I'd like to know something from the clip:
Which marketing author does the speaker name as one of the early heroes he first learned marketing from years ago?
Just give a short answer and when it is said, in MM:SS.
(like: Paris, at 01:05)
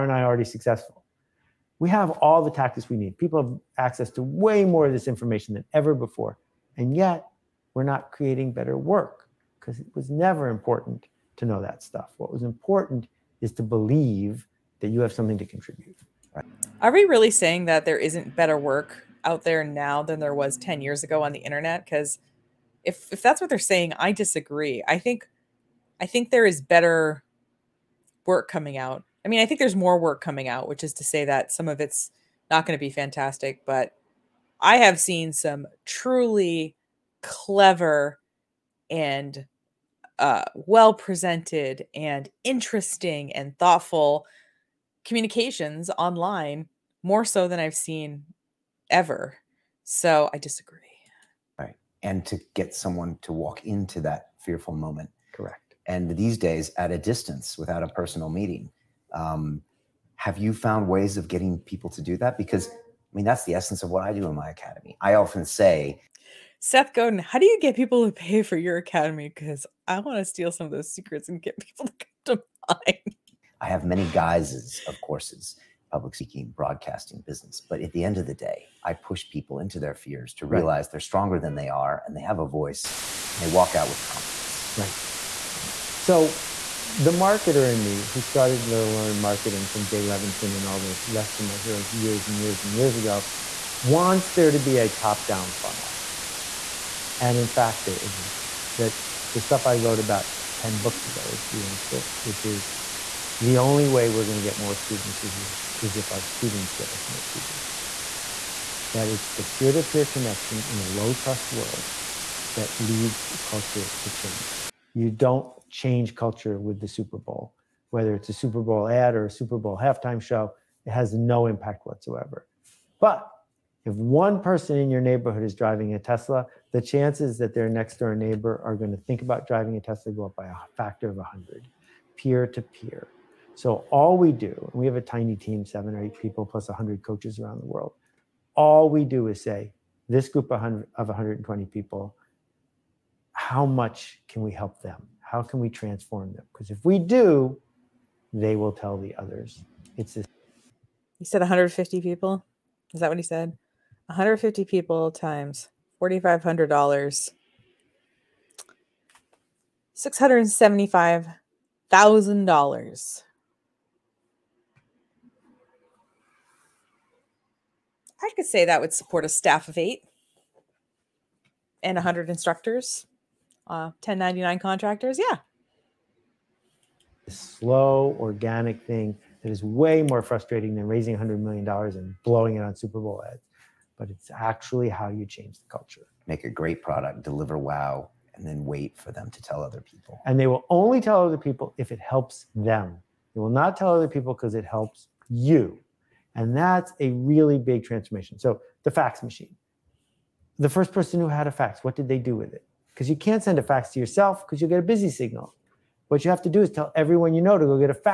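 Jay Levinson, at 01:29.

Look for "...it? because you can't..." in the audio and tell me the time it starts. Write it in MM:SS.
03:22.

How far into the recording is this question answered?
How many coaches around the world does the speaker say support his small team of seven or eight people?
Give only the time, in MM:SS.
02:16.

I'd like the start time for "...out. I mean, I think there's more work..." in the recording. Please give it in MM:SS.
00:28.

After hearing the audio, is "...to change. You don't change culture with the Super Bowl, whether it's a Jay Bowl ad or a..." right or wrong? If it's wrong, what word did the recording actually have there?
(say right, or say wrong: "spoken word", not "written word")
wrong: "Super", not "Jay".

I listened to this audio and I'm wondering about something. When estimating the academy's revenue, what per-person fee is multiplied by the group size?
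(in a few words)
$4,500.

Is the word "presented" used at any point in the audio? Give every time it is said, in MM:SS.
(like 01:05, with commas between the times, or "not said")
00:40.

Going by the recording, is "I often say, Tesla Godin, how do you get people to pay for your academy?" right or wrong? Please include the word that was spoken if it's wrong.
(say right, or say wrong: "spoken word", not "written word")
wrong: "Seth", not "Tesla".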